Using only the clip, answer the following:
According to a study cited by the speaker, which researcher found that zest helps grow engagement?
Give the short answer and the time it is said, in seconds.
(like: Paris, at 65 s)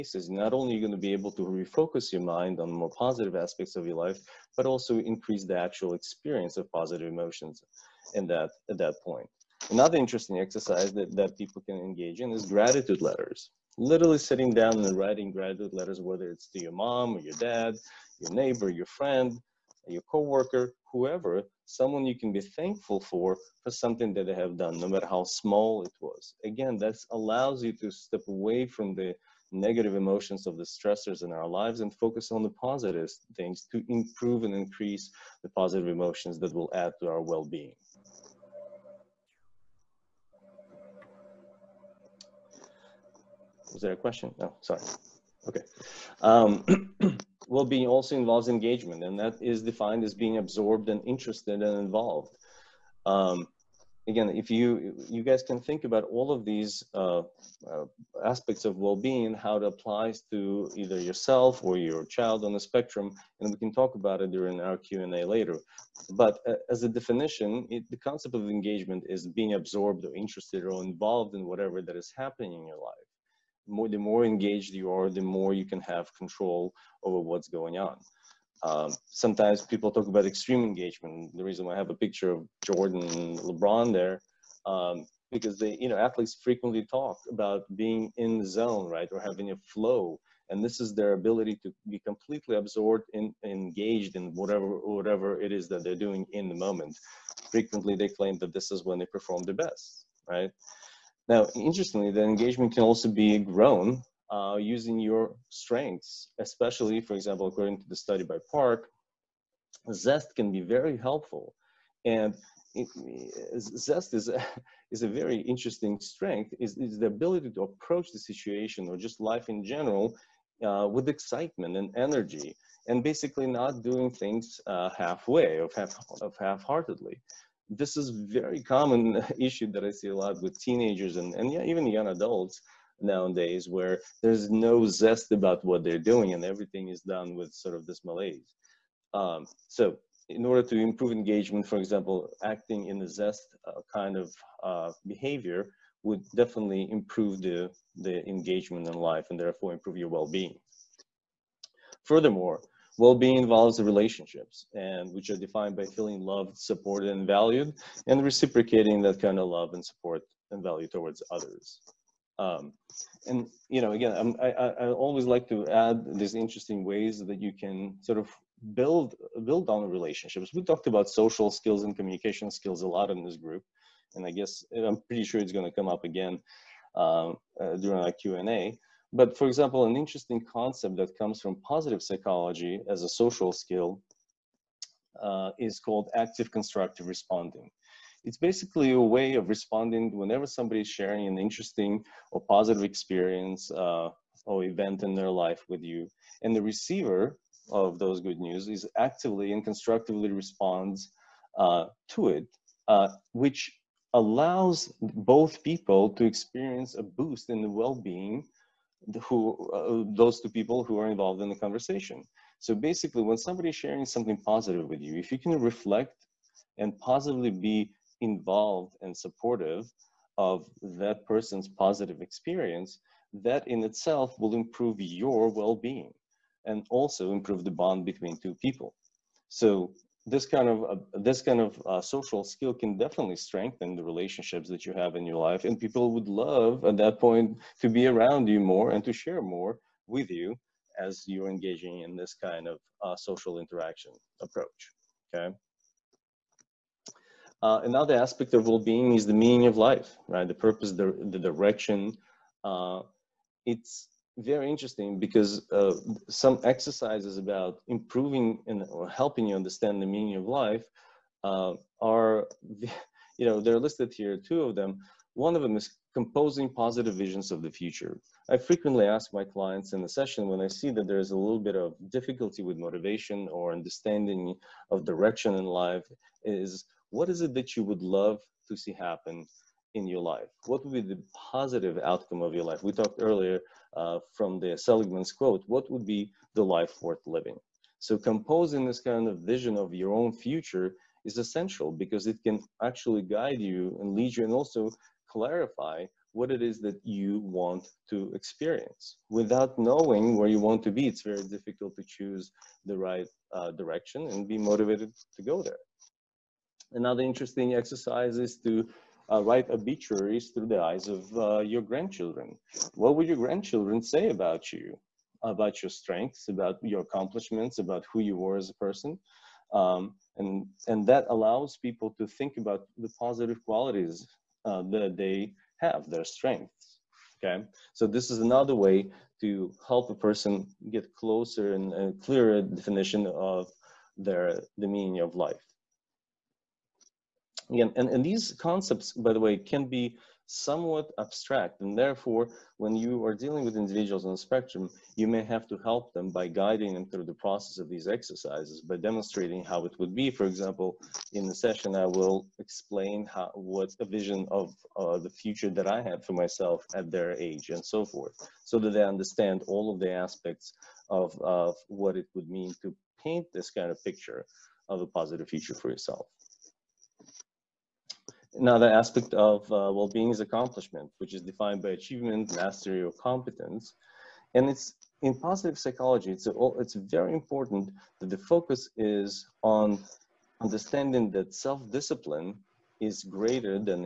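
Park, at 108 s.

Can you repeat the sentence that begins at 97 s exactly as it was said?
Frequently, they claim that this is when they perform the best, right?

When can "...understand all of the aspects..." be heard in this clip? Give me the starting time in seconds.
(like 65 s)
359 s.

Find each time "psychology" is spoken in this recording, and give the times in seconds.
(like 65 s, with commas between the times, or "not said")
182 s, 375 s.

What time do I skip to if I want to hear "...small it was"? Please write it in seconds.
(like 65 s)
25 s.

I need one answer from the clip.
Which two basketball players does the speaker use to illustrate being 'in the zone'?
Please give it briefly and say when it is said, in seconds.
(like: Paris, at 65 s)
Jordan and LeBron, at 82 s.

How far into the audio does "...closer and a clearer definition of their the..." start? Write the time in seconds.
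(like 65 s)
331 s.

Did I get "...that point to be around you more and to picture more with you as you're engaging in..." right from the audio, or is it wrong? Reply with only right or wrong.
wrong.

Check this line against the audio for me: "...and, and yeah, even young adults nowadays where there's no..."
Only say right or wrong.
right.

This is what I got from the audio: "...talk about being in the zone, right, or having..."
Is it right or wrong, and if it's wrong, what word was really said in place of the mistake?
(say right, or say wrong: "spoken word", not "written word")
right.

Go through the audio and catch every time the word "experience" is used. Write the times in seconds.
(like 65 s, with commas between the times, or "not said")
5 s, 192 s, 206 s, 222 s, 298 s.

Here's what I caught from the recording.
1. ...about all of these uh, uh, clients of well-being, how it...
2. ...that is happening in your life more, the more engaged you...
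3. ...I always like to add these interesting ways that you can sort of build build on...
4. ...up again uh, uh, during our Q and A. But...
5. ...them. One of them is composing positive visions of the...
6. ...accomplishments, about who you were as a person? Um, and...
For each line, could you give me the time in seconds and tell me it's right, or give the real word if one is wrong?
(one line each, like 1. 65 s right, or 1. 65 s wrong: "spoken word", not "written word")
1. 55 s wrong: "aspects", not "clients"
2. 71 s right
3. 164 s right
4. 175 s right
5. 264 s right
6. 317 s right.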